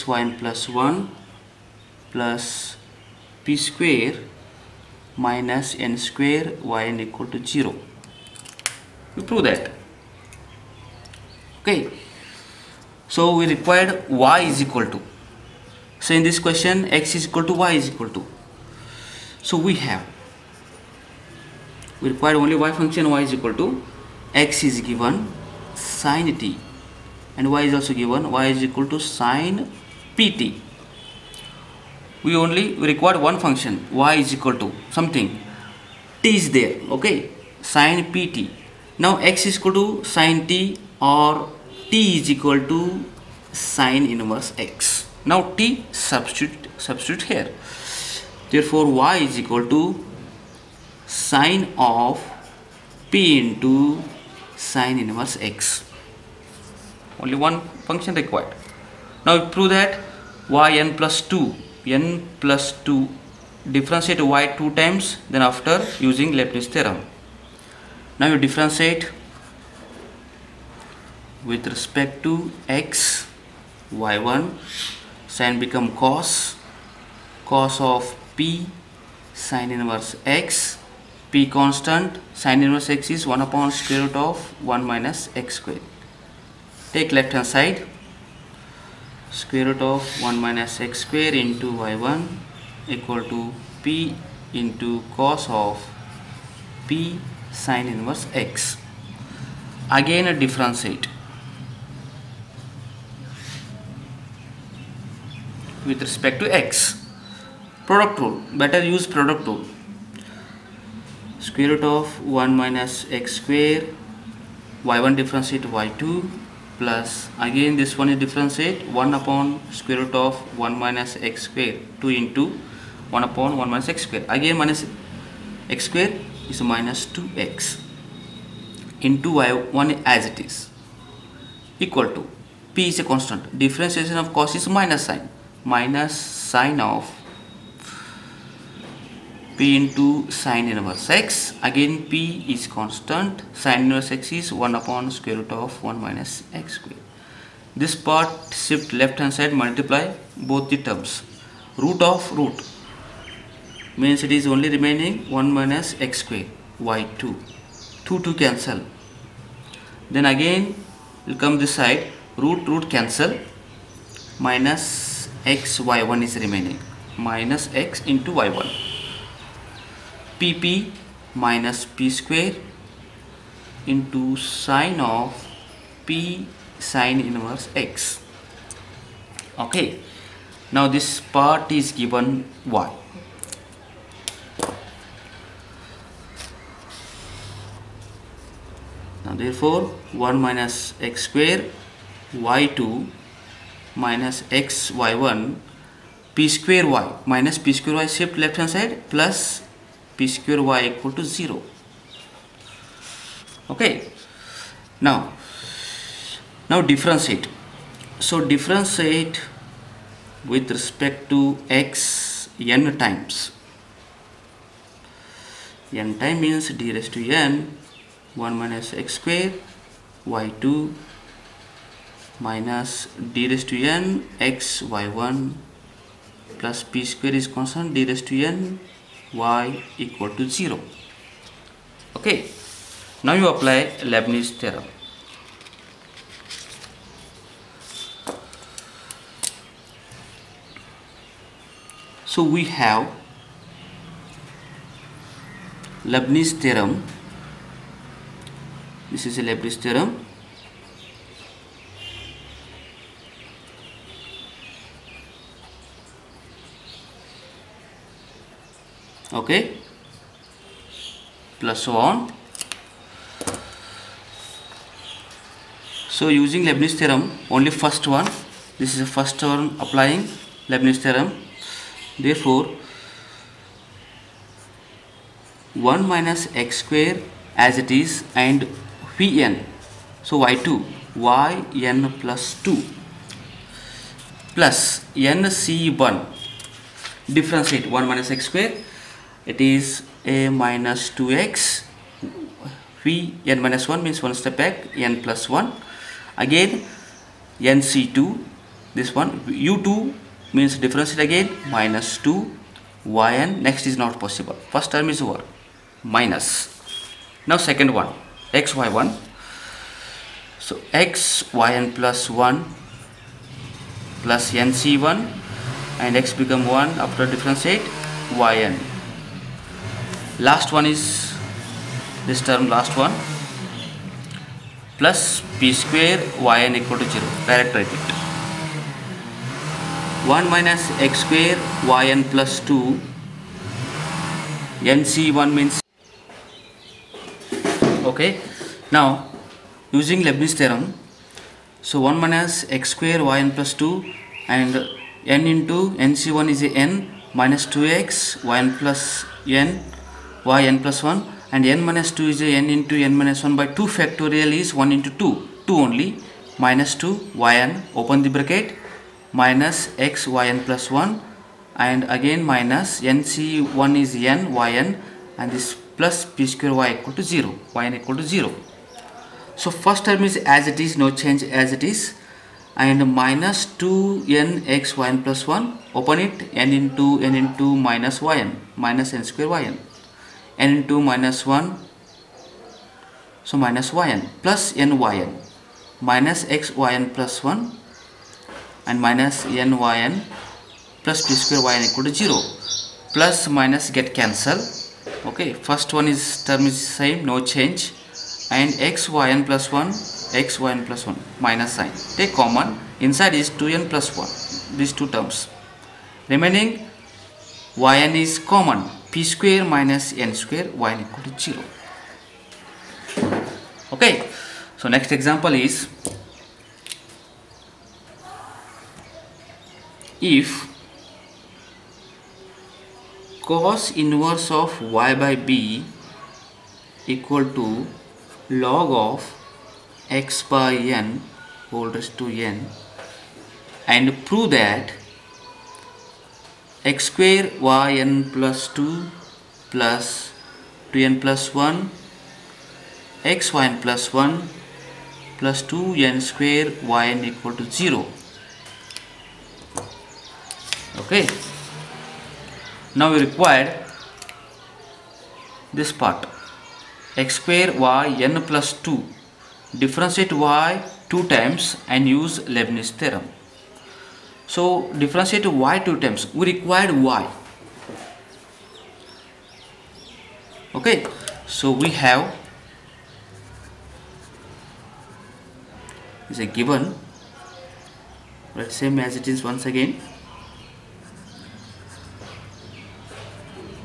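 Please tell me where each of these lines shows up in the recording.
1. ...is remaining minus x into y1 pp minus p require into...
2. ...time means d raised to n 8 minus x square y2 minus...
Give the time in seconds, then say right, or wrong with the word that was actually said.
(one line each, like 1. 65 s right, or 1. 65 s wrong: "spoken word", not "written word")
1. 166 s wrong: "square", not "require"
2. 216 s wrong: "1", not "8".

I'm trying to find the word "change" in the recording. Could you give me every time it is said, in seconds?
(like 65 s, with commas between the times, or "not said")
371 s, 397 s.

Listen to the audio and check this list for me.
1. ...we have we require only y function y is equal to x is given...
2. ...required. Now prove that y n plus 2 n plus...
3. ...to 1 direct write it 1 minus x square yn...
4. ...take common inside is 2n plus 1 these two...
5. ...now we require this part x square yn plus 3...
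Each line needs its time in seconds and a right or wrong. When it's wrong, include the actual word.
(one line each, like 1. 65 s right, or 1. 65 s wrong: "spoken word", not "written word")
1. 19 s right
2. 58 s right
3. 326 s wrong: "0", not "1"
4. 402 s right
5. 453 s wrong: "2", not "3".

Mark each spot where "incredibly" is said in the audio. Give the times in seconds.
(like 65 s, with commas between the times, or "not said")
not said.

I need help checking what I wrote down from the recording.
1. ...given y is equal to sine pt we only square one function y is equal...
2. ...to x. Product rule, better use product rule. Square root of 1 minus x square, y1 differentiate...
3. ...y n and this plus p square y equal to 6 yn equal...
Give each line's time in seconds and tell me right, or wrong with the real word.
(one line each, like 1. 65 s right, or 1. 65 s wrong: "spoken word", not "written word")
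1. 28 s wrong: "require", not "square"
2. 106 s right
3. 364 s wrong: "0", not "6".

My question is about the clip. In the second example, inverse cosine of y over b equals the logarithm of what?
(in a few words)
x by n.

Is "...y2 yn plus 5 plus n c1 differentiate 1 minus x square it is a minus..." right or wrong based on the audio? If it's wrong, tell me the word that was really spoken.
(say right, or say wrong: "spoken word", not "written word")
wrong: "2", not "5".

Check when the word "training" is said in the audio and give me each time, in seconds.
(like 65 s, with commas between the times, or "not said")
not said.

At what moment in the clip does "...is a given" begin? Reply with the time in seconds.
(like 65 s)
476 s.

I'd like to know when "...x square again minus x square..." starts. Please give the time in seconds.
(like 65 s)
123 s.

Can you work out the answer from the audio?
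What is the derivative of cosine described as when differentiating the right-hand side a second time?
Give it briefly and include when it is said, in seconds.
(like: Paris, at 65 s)
minus sine, at 133 s.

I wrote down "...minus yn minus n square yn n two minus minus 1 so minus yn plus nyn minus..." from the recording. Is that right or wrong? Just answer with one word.
right.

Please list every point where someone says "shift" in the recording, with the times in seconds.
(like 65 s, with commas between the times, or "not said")
148 s, 198 s.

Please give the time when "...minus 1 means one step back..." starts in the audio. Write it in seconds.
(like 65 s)
293 s.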